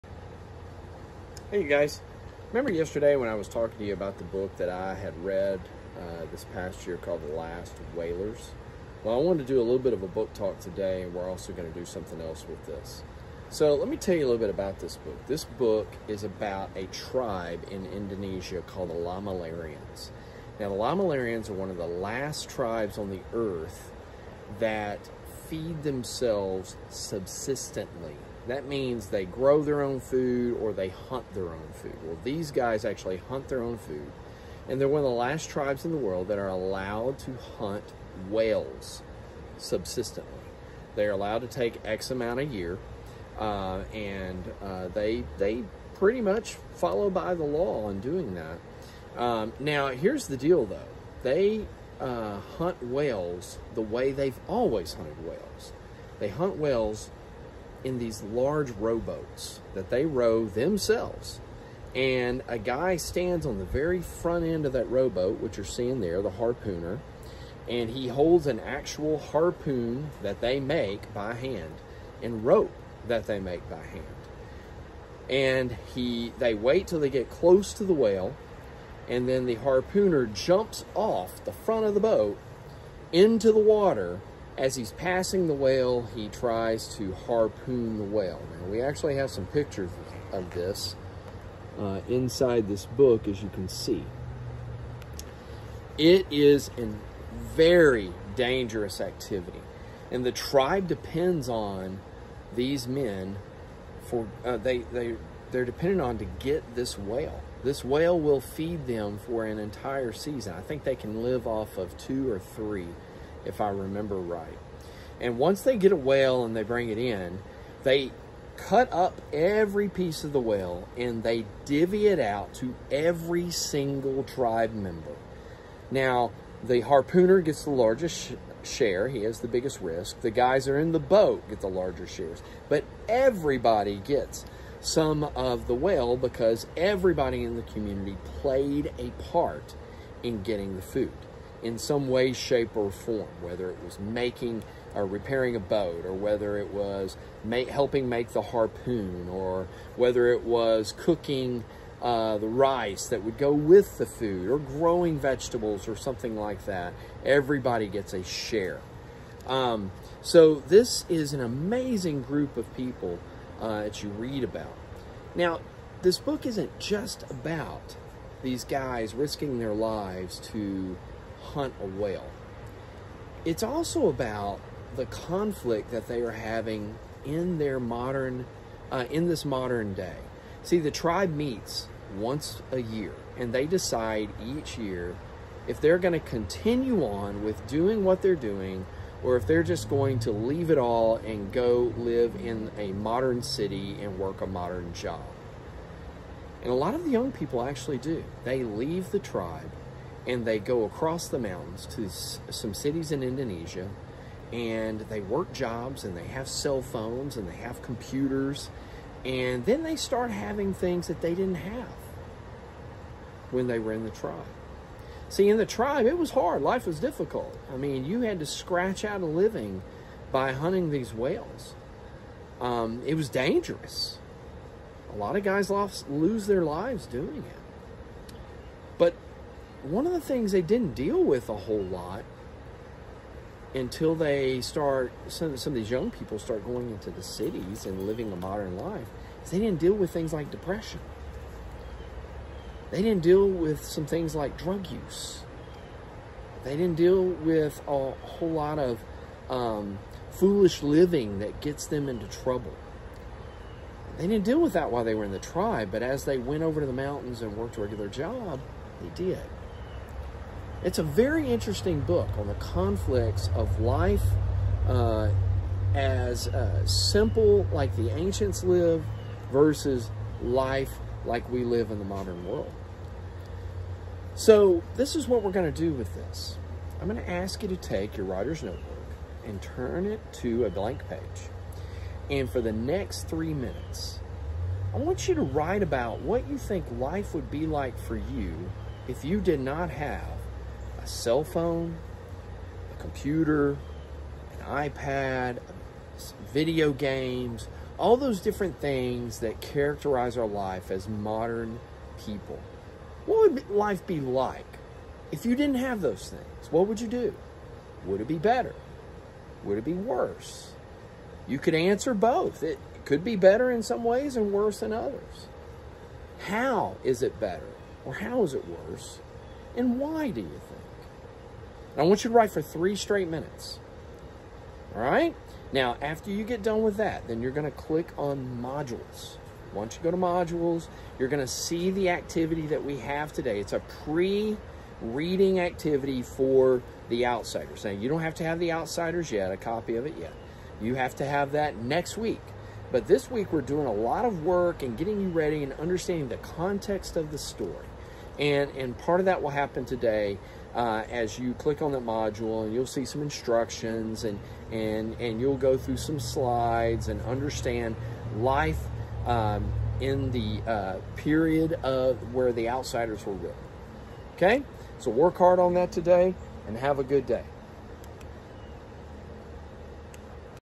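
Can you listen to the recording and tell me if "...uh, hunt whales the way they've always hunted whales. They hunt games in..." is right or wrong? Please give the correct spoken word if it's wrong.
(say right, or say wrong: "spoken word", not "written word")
wrong: "whales", not "games".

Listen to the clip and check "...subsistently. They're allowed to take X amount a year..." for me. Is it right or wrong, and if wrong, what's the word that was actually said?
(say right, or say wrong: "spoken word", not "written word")
right.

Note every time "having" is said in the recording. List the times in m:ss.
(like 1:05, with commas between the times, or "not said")
2:56, 3:30.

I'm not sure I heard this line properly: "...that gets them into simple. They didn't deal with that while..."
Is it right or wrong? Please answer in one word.
wrong.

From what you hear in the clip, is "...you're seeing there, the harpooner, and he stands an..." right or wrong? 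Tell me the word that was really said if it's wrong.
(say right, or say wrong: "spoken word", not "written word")
wrong: "holds", not "stands".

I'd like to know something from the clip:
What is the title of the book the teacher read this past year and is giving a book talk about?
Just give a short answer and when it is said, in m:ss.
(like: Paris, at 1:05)
The Last Whalers, at 0:07.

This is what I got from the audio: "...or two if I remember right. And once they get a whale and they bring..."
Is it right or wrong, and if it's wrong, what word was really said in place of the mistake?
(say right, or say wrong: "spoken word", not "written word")
wrong: "three", not "two".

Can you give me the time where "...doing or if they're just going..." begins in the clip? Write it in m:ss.
3:08.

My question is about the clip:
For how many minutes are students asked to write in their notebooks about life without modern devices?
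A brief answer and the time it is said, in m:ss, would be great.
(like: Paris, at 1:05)
3, at 4:43.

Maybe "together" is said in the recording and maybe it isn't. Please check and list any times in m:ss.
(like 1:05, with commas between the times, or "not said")
not said.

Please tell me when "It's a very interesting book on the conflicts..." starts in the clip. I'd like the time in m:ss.
4:20.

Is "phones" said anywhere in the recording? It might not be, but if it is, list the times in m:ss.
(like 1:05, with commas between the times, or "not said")
3:26, 4:51.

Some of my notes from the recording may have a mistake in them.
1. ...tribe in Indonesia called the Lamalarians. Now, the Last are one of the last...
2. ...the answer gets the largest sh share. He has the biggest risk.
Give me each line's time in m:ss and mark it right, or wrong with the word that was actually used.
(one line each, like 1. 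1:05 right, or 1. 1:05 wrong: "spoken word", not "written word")
1. 0:16 wrong: "Lamalarians", not "Last"
2. 2:06 wrong: "harpooner", not "answer".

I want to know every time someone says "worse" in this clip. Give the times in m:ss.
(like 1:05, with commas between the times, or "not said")
5:09, 5:14, 5:18.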